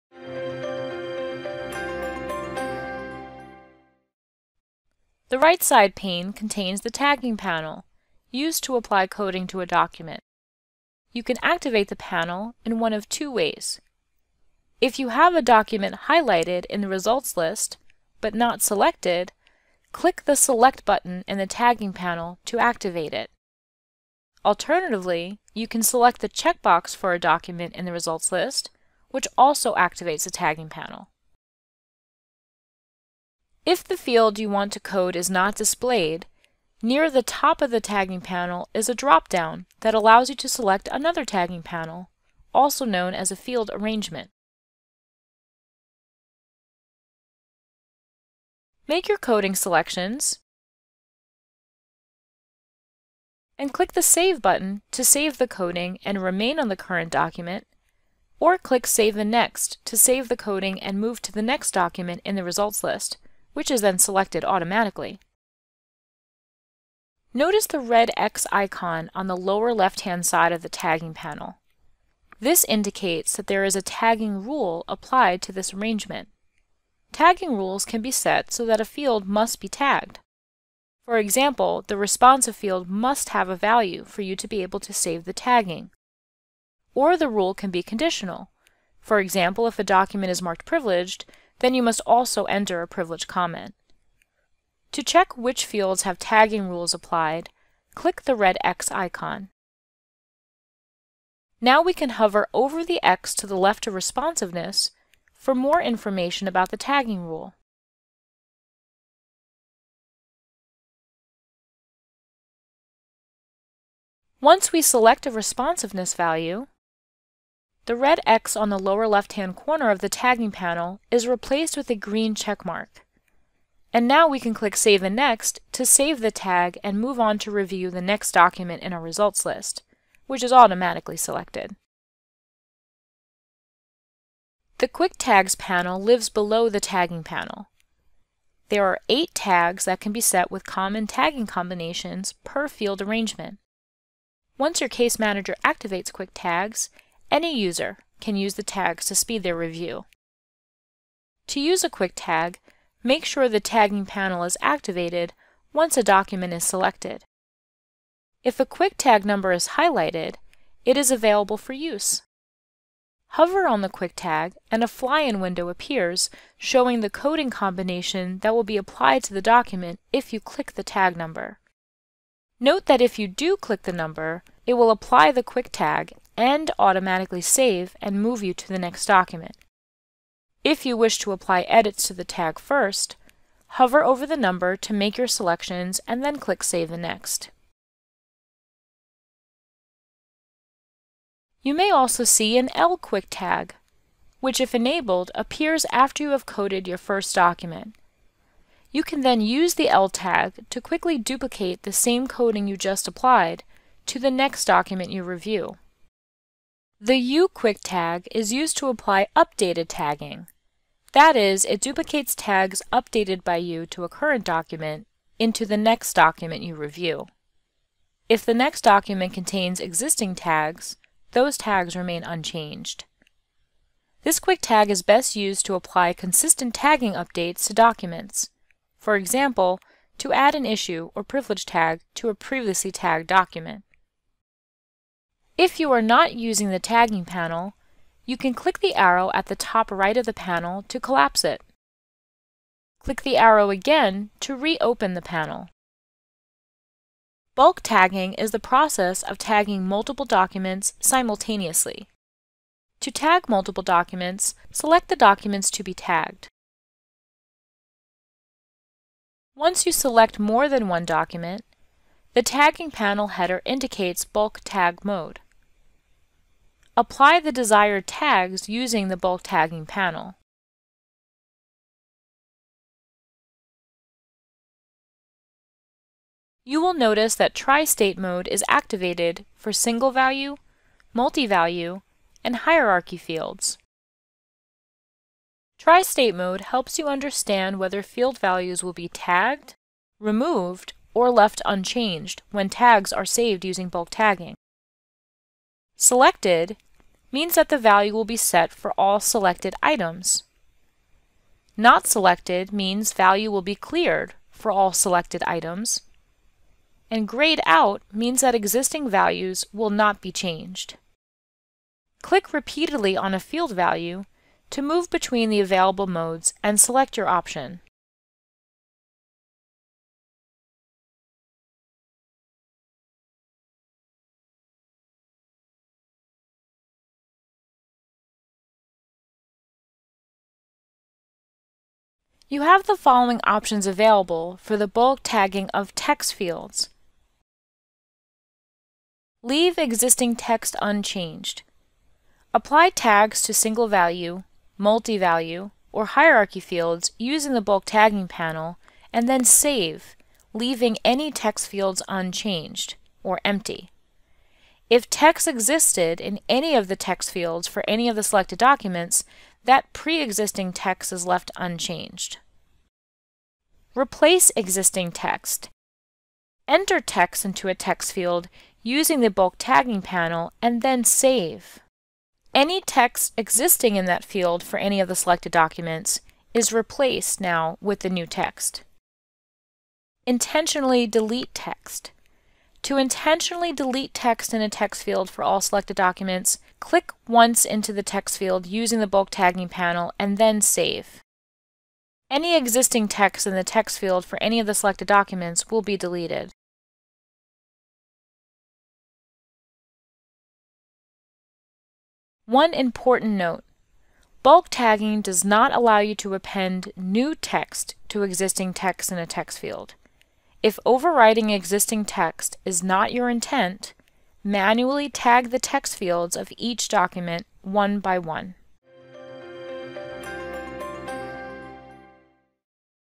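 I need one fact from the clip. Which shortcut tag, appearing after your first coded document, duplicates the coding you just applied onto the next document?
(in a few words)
L-Quick tag.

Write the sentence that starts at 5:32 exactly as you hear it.
You have the following options available for the bulk tagging of text fields.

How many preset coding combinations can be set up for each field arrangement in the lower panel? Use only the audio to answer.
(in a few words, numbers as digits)
8.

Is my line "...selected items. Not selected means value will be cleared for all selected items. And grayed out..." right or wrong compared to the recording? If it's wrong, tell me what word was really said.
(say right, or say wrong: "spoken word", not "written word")
right.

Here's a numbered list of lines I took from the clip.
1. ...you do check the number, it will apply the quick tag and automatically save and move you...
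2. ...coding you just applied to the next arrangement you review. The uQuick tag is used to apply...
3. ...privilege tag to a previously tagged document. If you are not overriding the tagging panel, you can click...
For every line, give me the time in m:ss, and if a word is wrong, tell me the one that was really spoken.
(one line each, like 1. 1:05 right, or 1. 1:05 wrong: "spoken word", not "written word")
1. 2:53 wrong: "click", not "check"
2. 3:22 wrong: "document", not "arrangement"
3. 3:51 wrong: "using", not "overriding".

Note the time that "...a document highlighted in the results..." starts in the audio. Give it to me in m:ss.
0:15.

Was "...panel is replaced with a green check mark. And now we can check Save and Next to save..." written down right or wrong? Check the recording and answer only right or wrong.
wrong.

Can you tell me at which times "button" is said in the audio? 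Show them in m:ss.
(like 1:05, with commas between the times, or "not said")
0:20, 0:54.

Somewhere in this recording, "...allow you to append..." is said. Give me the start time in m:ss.
6:45.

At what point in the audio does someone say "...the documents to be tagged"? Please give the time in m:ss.
4:15.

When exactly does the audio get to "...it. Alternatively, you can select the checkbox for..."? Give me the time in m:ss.
0:23.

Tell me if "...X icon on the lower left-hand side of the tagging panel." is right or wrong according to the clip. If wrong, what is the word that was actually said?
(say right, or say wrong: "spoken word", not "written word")
right.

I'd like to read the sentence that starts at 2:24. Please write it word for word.
Once your case manager activates Quick Tags, any user can use the tags to speed their review.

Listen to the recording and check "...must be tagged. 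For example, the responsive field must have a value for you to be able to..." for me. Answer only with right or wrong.
right.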